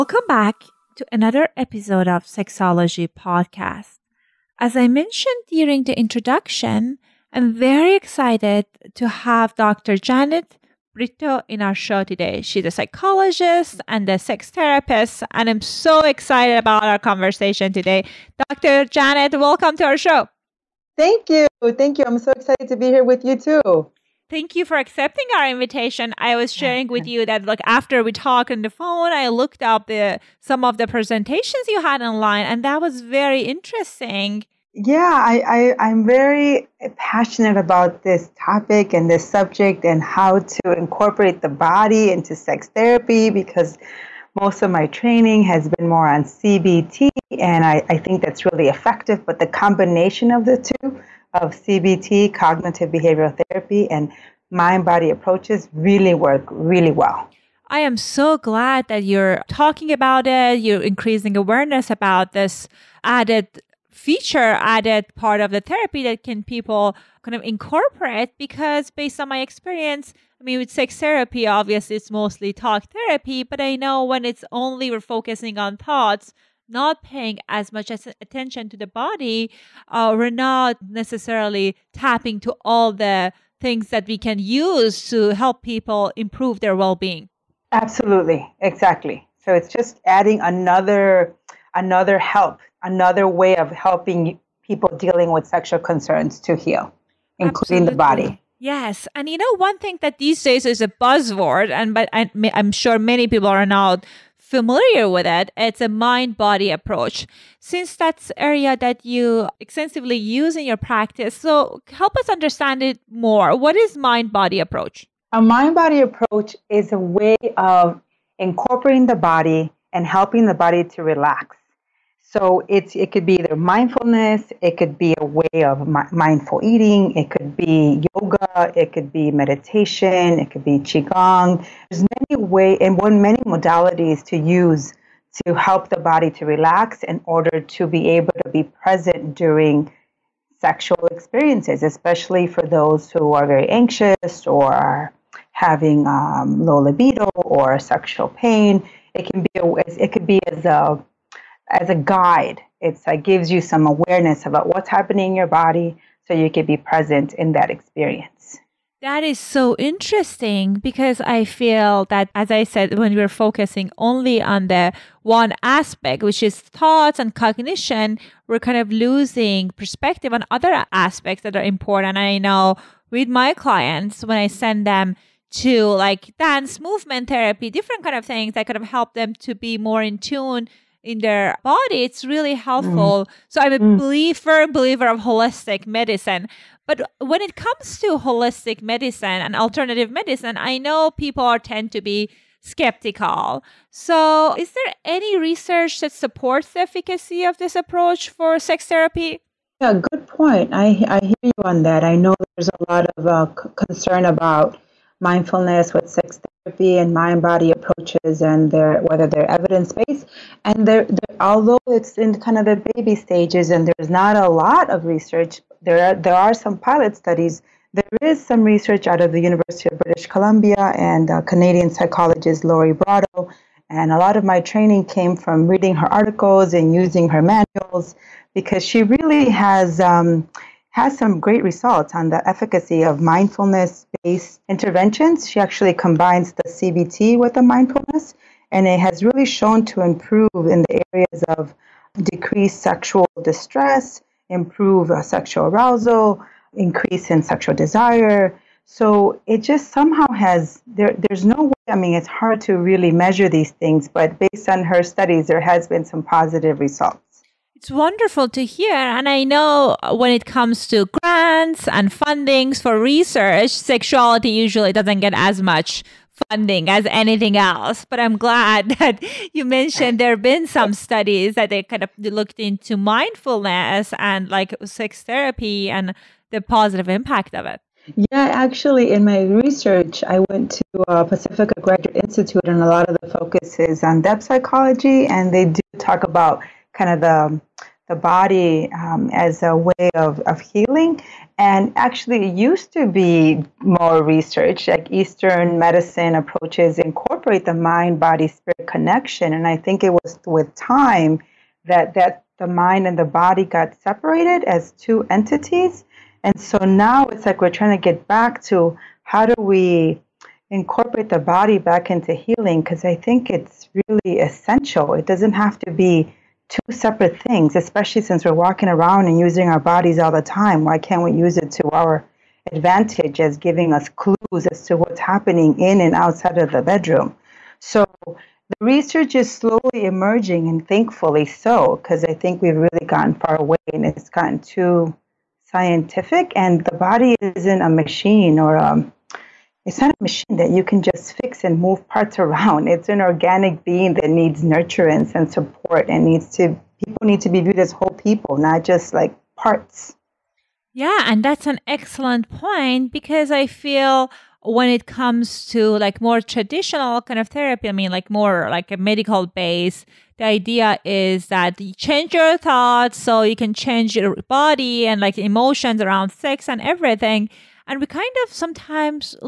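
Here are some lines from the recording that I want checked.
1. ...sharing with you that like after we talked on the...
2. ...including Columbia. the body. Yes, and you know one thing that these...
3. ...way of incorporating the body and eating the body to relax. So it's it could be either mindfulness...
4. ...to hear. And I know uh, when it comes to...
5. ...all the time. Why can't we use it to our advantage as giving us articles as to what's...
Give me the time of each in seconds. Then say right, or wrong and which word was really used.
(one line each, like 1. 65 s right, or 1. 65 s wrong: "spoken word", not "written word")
1. 26 s right
2. 97 s wrong: "Absolutely", not "Columbia"
3. 116 s wrong: "helping", not "eating"
4. 258 s right
5. 320 s wrong: "clues", not "articles".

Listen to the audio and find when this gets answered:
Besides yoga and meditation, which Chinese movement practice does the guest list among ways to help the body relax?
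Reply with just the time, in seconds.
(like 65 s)
130 s.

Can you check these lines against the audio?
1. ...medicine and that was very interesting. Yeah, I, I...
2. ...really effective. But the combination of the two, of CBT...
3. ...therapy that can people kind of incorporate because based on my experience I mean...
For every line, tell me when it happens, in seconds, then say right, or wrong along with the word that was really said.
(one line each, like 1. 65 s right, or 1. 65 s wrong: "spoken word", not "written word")
1. 32 s wrong: "online", not "medicine"
2. 48 s right
3. 65 s right.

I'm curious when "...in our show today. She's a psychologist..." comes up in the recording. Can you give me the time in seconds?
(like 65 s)
11 s.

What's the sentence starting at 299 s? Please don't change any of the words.
And I think it was with time that, that the mind and the body got separated as two entities.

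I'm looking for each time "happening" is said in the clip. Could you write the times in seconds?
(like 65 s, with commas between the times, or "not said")
154 s, 325 s.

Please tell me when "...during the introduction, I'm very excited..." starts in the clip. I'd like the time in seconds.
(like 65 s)
5 s.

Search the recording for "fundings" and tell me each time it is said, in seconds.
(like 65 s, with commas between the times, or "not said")
262 s, 266 s.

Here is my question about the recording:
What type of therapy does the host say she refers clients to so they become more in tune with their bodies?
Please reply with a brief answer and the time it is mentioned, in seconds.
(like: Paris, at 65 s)
dance movement therapy, at 176 s.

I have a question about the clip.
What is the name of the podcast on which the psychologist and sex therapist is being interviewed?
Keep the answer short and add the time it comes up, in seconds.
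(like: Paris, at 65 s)
Sexology Podcast, at 2 s.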